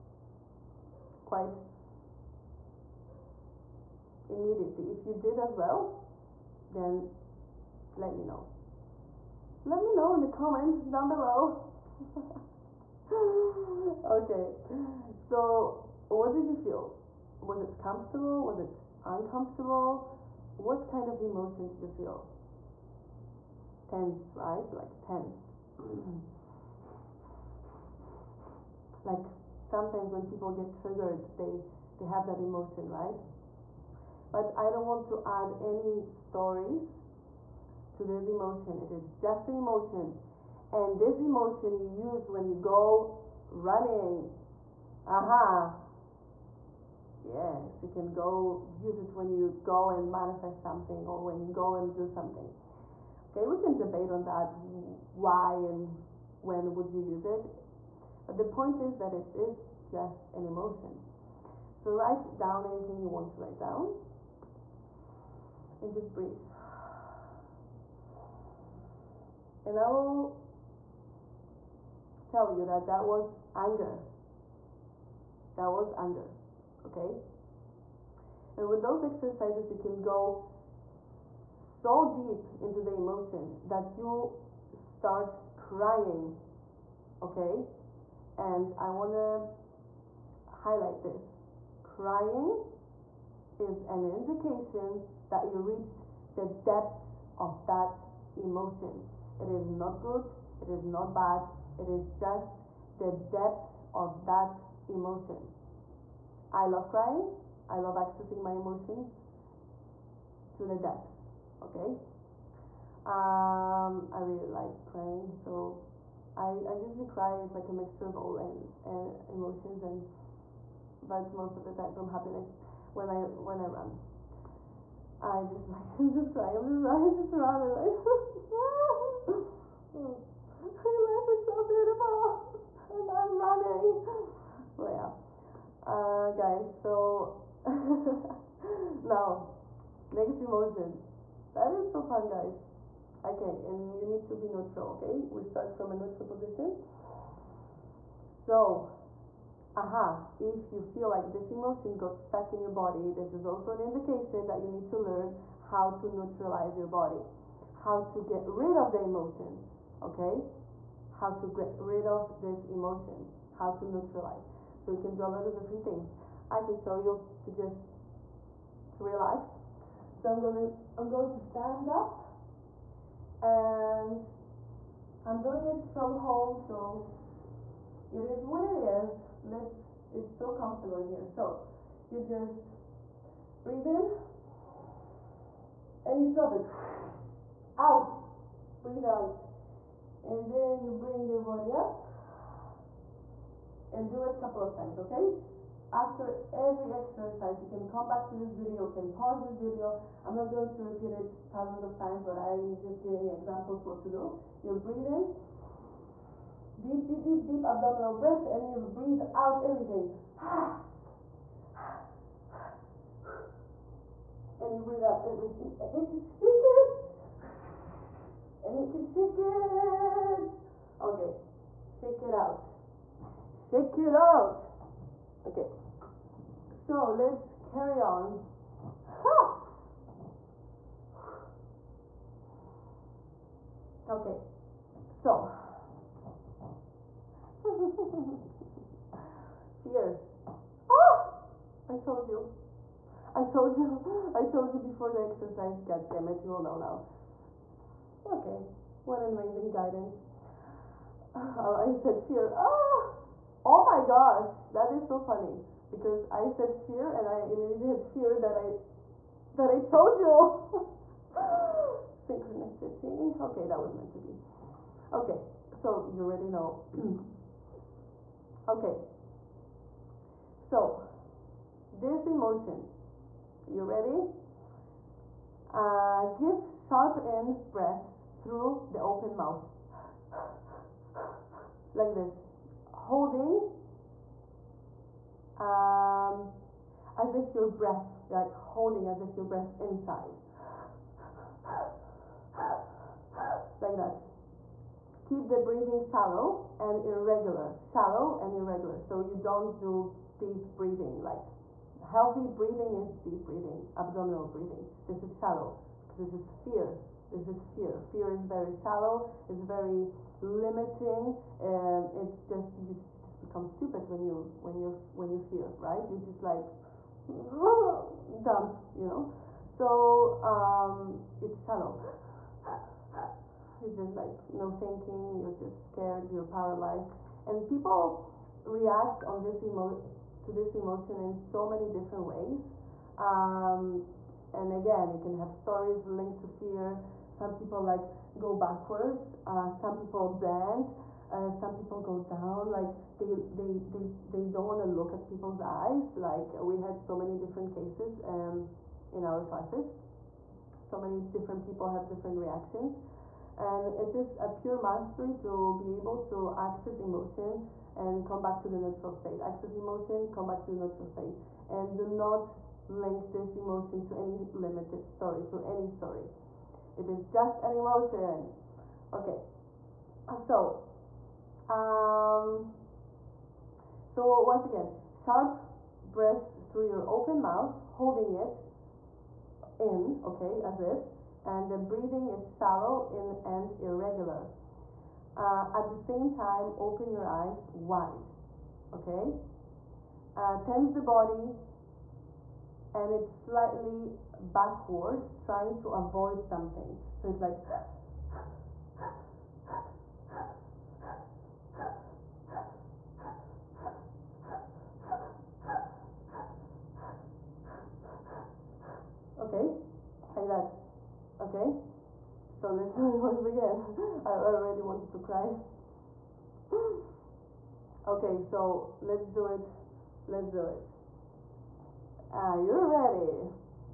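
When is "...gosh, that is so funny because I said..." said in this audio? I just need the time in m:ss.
4:14.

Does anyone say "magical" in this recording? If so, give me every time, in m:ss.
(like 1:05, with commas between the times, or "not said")
not said.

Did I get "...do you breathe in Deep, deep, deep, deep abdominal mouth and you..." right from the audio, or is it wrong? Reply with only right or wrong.
wrong.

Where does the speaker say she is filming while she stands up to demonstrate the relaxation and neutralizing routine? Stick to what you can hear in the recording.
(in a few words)
home.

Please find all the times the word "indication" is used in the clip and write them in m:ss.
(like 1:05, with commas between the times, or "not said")
1:34, 2:33.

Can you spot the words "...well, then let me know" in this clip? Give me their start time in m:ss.
0:05.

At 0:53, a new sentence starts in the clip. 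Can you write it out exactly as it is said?
Okay, we can debate on that why and when would you use it.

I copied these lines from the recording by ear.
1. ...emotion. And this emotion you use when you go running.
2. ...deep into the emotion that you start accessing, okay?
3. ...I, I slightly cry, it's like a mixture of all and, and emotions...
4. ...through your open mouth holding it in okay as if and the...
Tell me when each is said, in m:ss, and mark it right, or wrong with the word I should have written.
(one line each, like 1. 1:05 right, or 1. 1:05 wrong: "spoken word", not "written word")
1. 0:39 right
2. 1:22 wrong: "crying", not "accessing"
3. 1:56 wrong: "usually", not "slightly"
4. 6:16 right.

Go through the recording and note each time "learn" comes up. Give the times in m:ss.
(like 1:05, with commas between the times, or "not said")
2:34.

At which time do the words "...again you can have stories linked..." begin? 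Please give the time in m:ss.
5:34.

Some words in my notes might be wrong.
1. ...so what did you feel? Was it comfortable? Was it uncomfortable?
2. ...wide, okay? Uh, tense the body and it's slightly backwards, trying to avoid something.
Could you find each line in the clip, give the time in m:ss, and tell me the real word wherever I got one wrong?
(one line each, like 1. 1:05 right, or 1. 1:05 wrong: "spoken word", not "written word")
1. 0:15 right
2. 6:27 right.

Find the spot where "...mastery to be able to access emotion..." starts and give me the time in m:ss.
5:54.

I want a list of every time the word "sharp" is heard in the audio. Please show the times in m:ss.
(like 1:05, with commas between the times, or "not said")
4:36, 6:15.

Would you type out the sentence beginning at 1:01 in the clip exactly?
So write down anything you want to write down and just breathe.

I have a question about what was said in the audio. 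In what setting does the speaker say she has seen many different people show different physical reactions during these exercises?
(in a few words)
in our classes.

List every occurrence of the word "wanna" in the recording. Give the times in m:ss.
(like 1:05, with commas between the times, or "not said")
1:28.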